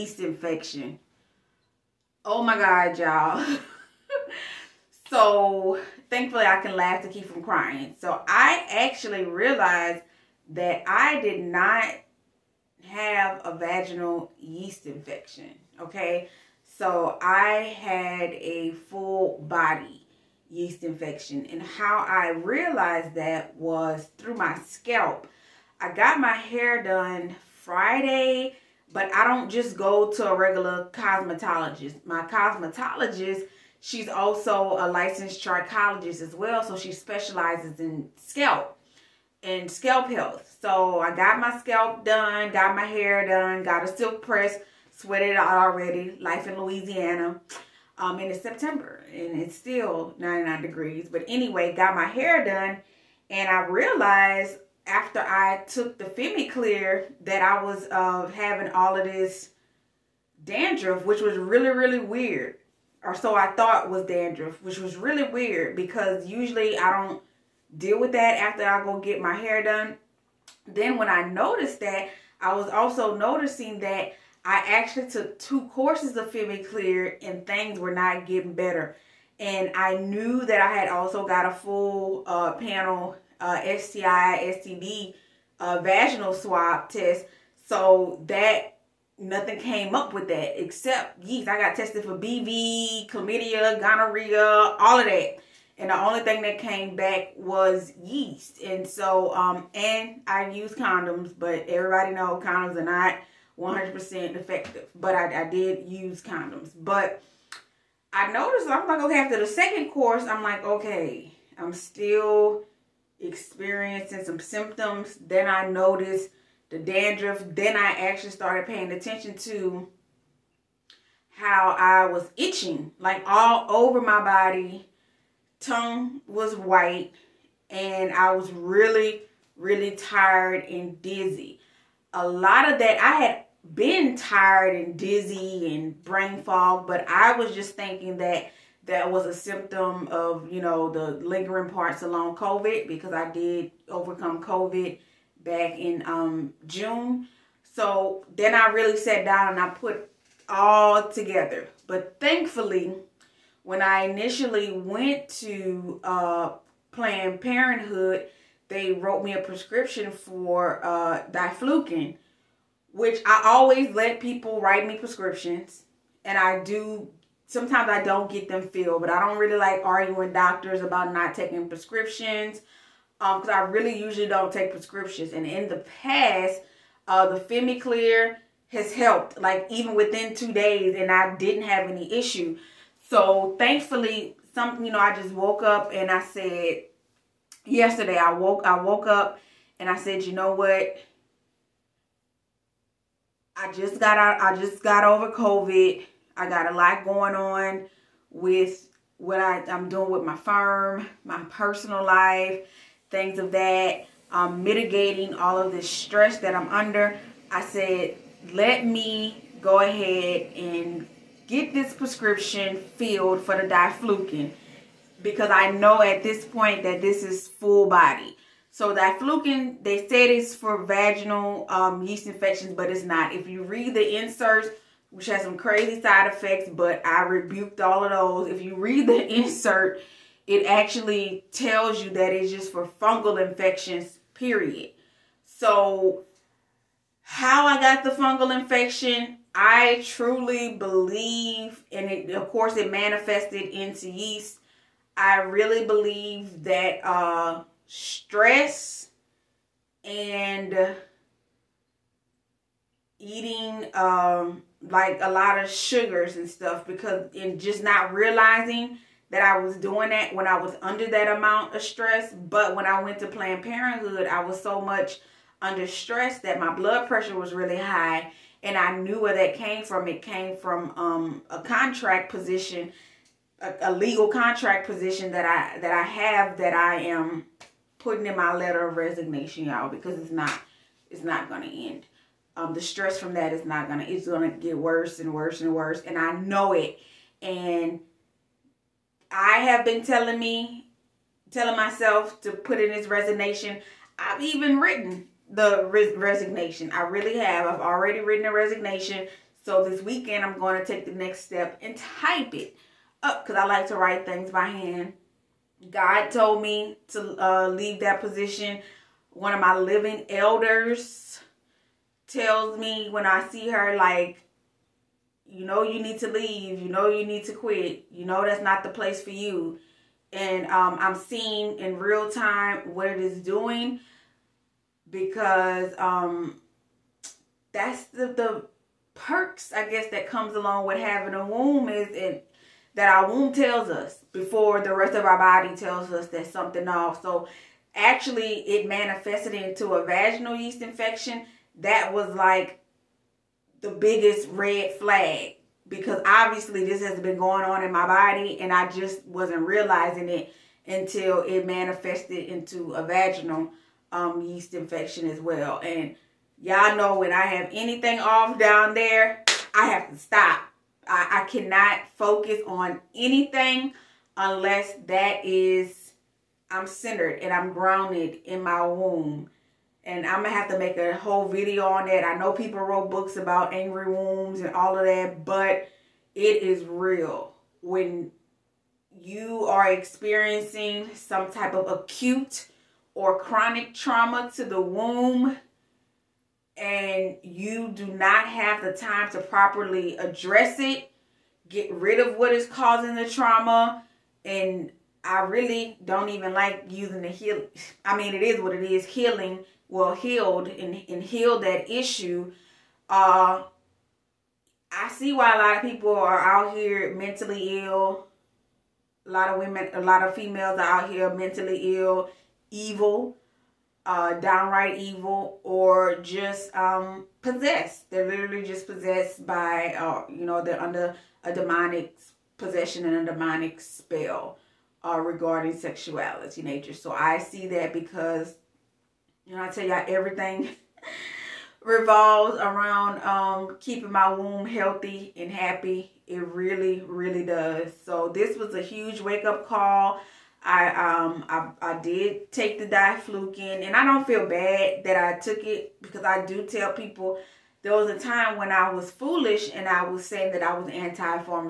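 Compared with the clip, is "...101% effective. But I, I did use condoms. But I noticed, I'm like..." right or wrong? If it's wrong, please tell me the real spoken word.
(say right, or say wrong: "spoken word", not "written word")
wrong: "100", not "101".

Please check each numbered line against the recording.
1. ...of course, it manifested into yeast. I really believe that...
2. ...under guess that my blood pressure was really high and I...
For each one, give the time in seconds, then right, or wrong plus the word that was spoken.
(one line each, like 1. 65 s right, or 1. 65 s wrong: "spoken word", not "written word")
1. 242 s right
2. 265 s wrong: "stress", not "guess".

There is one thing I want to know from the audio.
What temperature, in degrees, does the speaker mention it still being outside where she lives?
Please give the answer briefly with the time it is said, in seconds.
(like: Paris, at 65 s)
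99, at 50 s.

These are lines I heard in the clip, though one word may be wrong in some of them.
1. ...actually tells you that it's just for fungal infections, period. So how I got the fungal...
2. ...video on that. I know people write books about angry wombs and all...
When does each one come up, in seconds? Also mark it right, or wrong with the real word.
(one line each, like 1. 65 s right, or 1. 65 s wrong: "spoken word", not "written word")
1. 230 s right
2. 371 s wrong: "wrote", not "write".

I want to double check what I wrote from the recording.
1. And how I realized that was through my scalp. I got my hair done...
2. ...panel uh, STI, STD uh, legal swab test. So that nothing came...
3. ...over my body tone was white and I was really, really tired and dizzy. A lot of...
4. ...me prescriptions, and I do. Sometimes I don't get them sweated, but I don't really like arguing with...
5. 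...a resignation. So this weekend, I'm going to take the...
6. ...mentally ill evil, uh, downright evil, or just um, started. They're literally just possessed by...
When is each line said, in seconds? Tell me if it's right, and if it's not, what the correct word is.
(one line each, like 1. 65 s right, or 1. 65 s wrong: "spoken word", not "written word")
1. 21 s right
2. 82 s wrong: "vaginal", not "legal"
3. 123 s right
4. 164 s wrong: "filled", not "sweated"
5. 298 s right
6. 411 s wrong: "possessed", not "started".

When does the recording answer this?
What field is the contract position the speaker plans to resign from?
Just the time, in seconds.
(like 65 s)
273 s.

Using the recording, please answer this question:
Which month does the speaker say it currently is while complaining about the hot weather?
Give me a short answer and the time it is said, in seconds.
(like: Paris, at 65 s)
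September, at 48 s.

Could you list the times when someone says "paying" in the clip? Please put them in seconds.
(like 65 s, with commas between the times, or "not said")
118 s.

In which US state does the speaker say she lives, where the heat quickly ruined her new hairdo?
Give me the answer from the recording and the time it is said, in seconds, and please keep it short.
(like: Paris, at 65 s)
Louisiana, at 46 s.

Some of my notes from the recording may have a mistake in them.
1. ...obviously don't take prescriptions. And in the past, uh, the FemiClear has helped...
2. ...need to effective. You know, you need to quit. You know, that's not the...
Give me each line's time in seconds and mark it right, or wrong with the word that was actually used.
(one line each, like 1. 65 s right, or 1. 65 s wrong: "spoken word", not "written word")
1. 174 s wrong: "usually", not "obviously"
2. 316 s wrong: "leave", not "effective".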